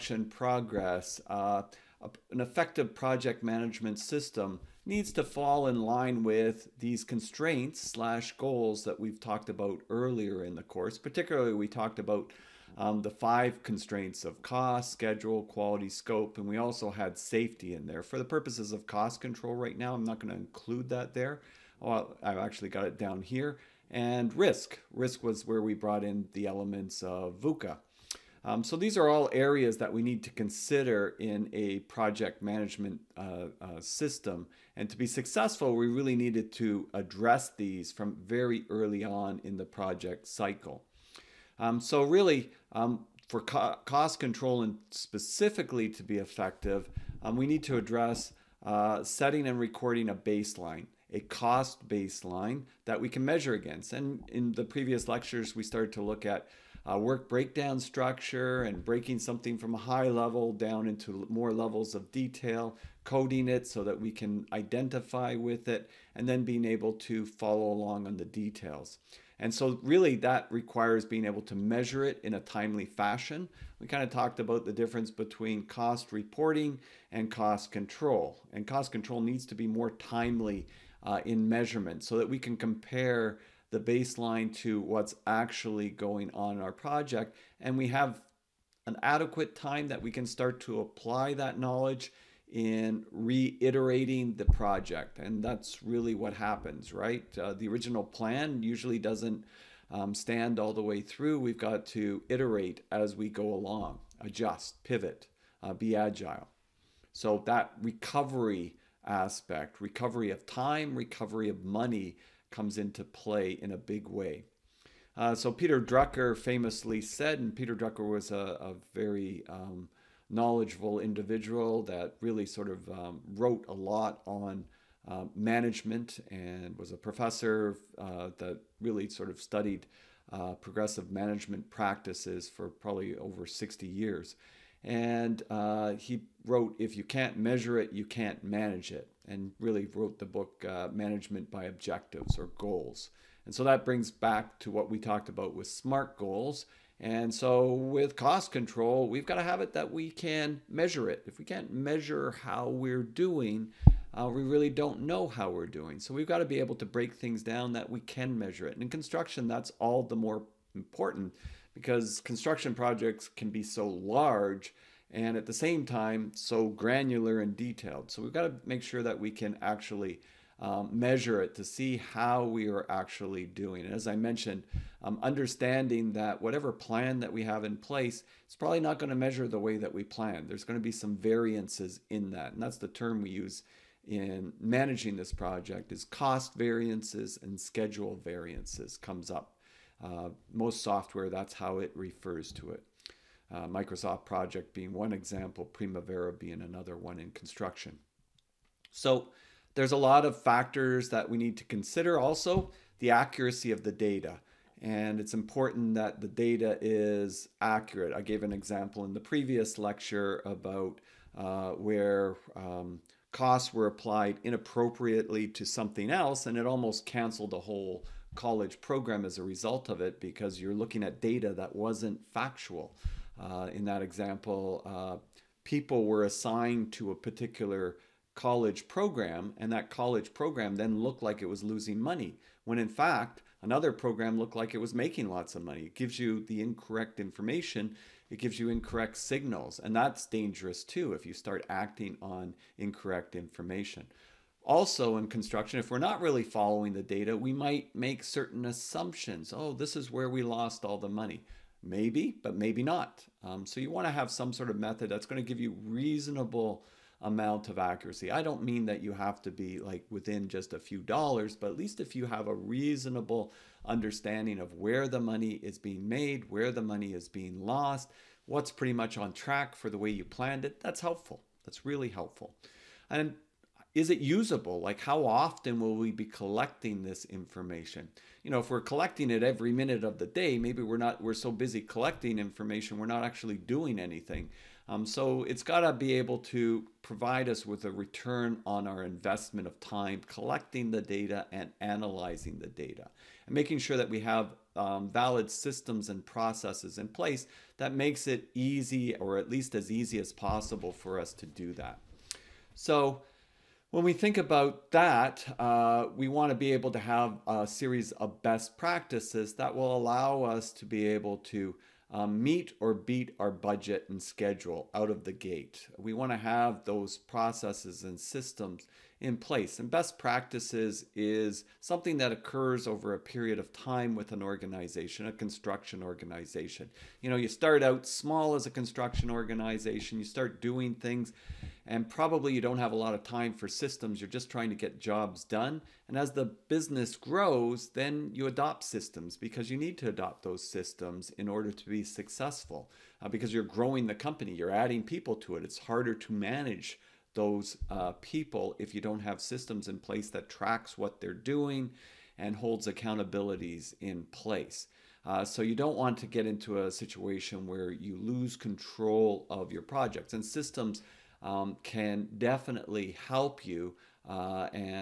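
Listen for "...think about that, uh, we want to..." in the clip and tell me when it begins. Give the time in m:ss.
5:04.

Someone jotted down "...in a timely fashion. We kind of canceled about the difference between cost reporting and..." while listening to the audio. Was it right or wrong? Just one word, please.
wrong.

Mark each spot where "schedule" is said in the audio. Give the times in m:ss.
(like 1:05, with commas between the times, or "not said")
0:14, 3:07, 5:14.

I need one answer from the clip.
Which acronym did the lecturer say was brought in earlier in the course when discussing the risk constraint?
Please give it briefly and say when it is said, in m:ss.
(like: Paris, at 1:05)
VUCA, at 0:27.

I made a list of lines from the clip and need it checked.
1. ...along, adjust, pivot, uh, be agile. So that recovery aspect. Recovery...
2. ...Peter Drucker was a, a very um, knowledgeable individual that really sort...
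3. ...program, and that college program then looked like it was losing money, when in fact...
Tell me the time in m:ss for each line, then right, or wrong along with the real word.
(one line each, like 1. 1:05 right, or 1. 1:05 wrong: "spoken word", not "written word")
1. 1:43 right
2. 1:57 right
3. 3:48 right.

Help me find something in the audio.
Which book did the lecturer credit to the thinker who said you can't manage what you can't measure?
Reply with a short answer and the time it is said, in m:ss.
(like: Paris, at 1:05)
Management by Objectives, at 2:20.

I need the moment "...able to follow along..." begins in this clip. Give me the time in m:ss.
1:06.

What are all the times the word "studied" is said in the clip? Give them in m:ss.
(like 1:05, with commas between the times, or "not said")
2:09.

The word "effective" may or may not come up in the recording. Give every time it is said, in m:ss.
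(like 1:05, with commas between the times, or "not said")
0:02, 0:46.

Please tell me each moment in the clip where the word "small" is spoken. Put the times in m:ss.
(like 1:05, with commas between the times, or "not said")
5:28.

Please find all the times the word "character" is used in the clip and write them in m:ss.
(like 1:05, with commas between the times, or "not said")
not said.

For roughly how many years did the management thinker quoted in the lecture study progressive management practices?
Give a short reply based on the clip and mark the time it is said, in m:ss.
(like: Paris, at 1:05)
over 60 years, at 2:13.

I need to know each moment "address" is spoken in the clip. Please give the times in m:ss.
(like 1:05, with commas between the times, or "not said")
0:36, 0:47.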